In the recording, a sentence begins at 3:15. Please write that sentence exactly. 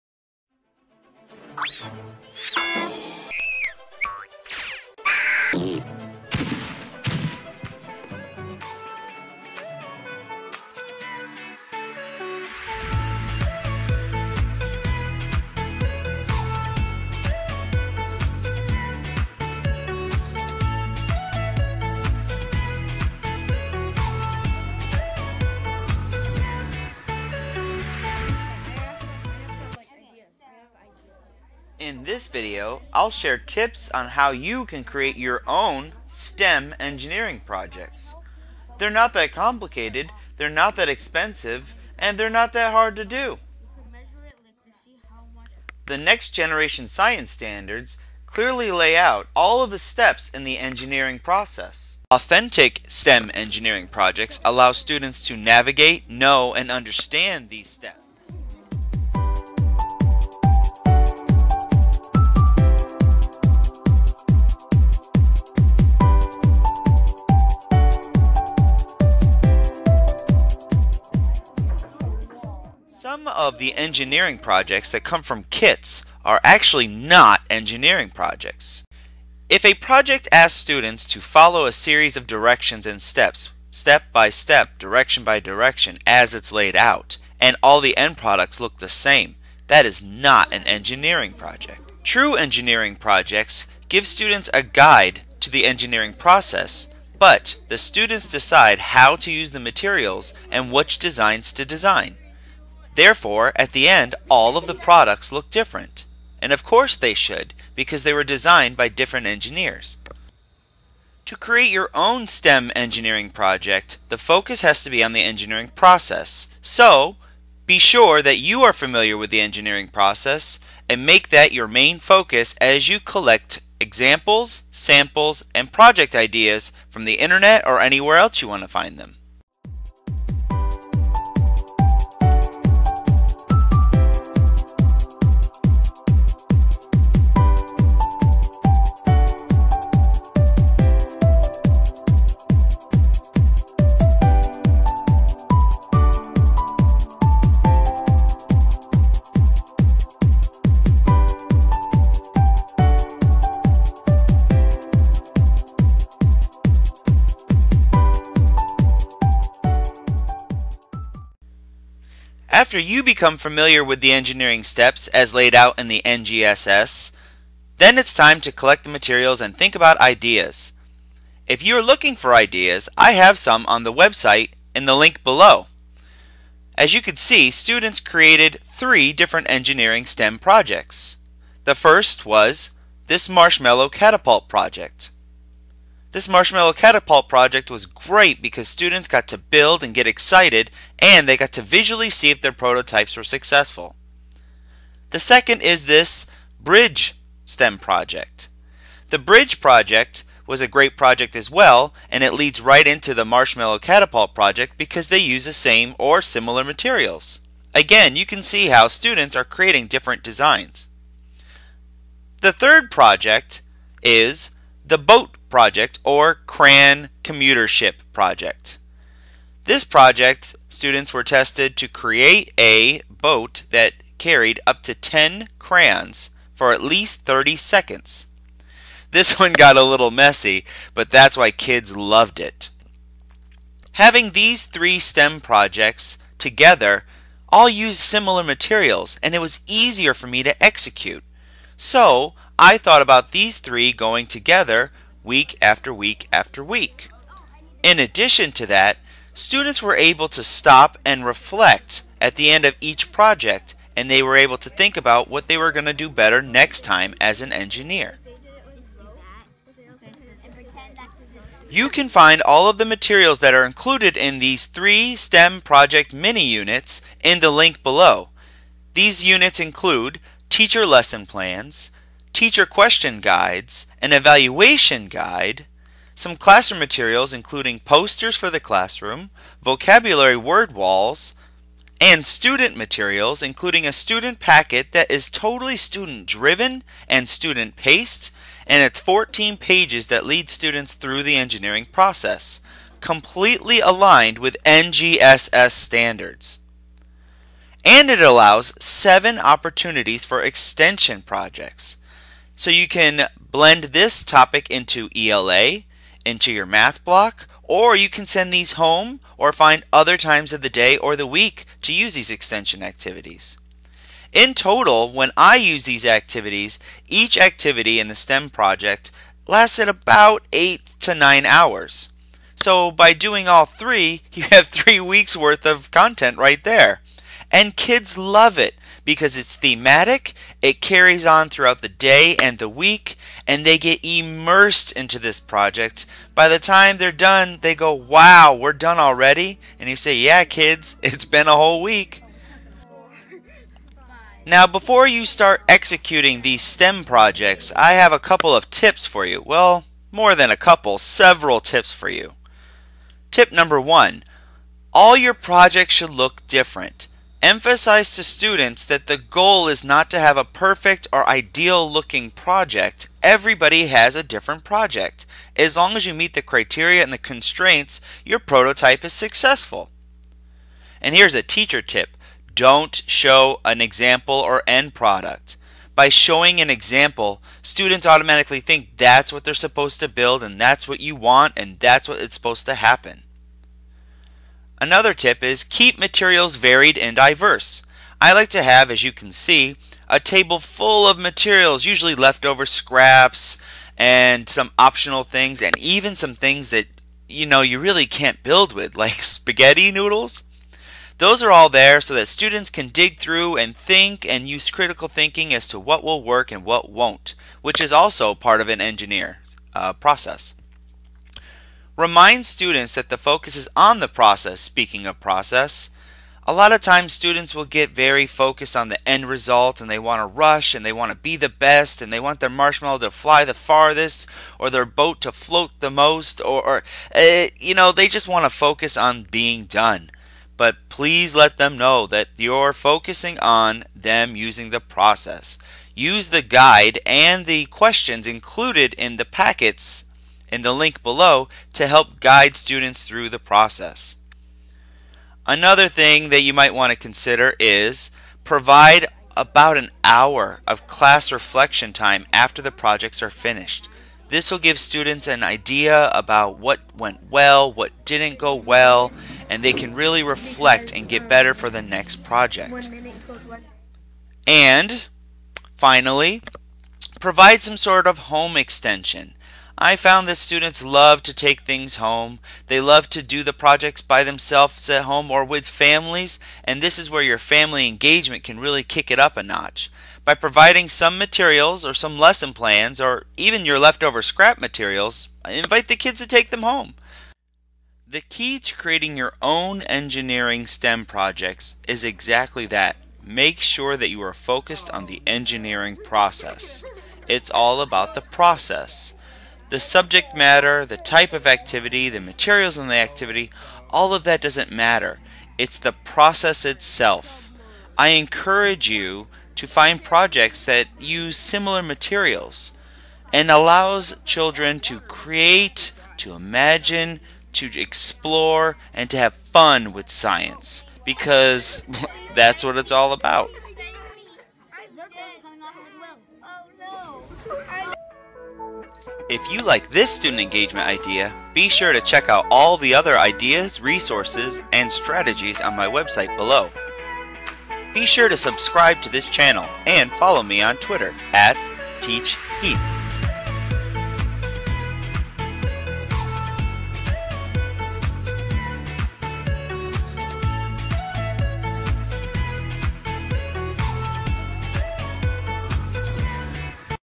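The second is this Bridge STEM project.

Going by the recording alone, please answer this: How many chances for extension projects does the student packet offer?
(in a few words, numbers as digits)
7.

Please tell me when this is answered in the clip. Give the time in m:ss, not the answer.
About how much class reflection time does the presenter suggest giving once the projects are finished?
7:29.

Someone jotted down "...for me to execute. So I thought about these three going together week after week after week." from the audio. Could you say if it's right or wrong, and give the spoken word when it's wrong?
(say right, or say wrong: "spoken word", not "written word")
right.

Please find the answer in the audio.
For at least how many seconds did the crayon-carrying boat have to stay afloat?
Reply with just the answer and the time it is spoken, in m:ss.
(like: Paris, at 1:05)
30, at 3:47.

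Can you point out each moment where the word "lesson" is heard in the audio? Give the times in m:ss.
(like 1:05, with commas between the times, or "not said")
4:30, 8:02.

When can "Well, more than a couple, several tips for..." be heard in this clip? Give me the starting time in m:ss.
5:49.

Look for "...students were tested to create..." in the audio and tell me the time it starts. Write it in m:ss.
3:40.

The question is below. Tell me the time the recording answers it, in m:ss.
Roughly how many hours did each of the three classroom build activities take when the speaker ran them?
5:20.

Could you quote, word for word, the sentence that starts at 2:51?
If you are looking for ideas, I have some on the website in the link below.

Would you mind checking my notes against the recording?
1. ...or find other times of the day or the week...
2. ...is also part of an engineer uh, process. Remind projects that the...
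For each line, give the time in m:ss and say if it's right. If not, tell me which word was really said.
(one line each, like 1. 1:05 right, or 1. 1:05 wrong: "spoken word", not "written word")
1. 5:09 right
2. 6:47 wrong: "students", not "projects".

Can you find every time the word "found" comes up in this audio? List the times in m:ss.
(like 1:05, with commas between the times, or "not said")
7:49.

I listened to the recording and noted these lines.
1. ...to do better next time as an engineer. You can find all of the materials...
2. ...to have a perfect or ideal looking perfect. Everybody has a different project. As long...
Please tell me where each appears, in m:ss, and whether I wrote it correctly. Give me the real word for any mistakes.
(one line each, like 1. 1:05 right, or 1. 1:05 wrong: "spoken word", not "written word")
1. 4:15 right
2. 6:00 wrong: "project", not "perfect".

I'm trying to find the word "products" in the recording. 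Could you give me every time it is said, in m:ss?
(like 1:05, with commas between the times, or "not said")
1:28, 1:44, 6:14.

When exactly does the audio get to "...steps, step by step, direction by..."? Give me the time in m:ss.
1:23.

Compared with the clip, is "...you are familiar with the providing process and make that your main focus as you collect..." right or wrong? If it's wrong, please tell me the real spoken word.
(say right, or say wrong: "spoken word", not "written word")
wrong: "engineering", not "providing".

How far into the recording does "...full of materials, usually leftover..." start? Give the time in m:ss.
6:30.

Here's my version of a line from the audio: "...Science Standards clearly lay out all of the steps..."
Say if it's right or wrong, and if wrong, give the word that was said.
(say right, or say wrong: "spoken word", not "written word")
right.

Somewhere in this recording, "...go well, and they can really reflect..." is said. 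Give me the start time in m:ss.
7:38.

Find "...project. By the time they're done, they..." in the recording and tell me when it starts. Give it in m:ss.
5:35.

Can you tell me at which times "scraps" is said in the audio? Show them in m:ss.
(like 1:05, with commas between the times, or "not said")
6:32, 8:04.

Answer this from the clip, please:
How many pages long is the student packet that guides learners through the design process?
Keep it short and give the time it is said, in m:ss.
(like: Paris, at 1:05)
14, at 4:48.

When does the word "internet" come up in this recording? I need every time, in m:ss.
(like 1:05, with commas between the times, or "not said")
2:07.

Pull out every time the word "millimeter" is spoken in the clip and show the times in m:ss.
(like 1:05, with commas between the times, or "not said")
not said.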